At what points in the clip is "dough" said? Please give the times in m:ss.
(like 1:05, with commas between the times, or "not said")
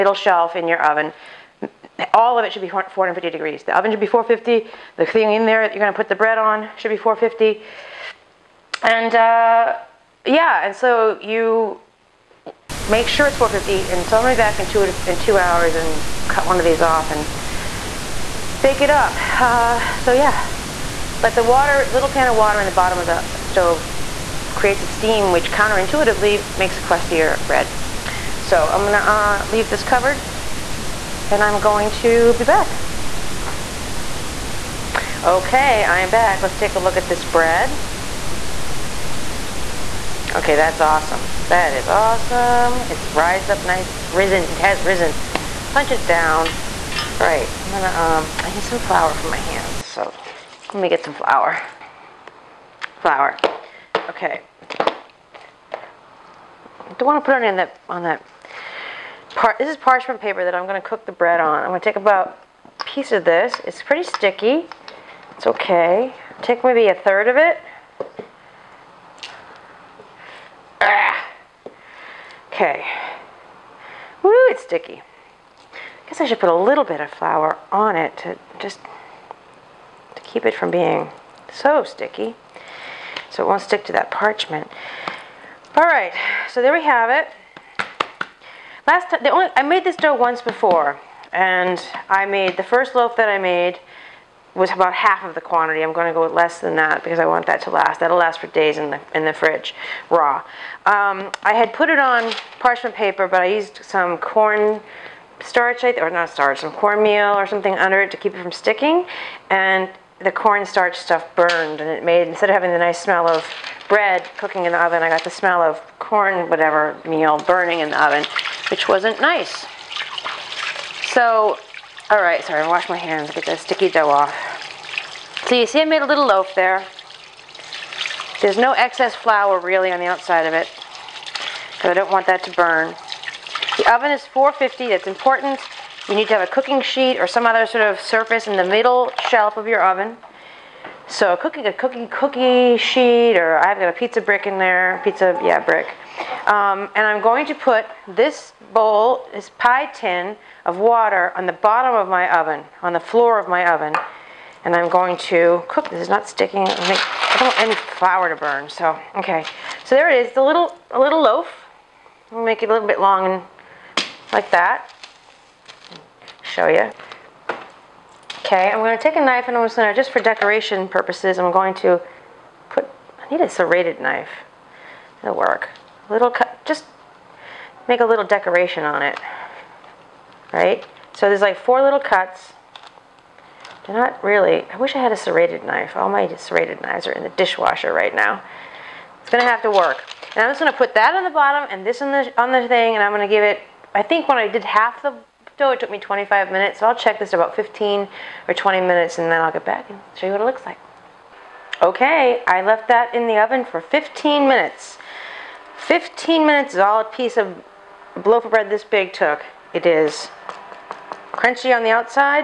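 1:29, 2:03.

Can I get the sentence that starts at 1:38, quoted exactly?
That'll last for days in the, in the fridge, raw.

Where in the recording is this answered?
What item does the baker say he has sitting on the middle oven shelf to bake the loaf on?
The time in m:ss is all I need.
2:23.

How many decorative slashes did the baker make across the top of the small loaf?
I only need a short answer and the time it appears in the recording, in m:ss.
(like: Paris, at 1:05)
4, at 3:01.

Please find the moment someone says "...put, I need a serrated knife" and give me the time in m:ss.
2:52.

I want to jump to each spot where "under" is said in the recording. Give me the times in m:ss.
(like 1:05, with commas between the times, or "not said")
1:47.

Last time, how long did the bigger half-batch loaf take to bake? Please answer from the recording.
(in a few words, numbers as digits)
25 minutes.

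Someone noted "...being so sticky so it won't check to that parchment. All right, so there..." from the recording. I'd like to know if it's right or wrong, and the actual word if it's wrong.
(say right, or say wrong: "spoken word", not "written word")
wrong: "stick", not "check".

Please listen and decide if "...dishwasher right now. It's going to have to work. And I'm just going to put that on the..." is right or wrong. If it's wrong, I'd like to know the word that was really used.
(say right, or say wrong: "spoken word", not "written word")
right.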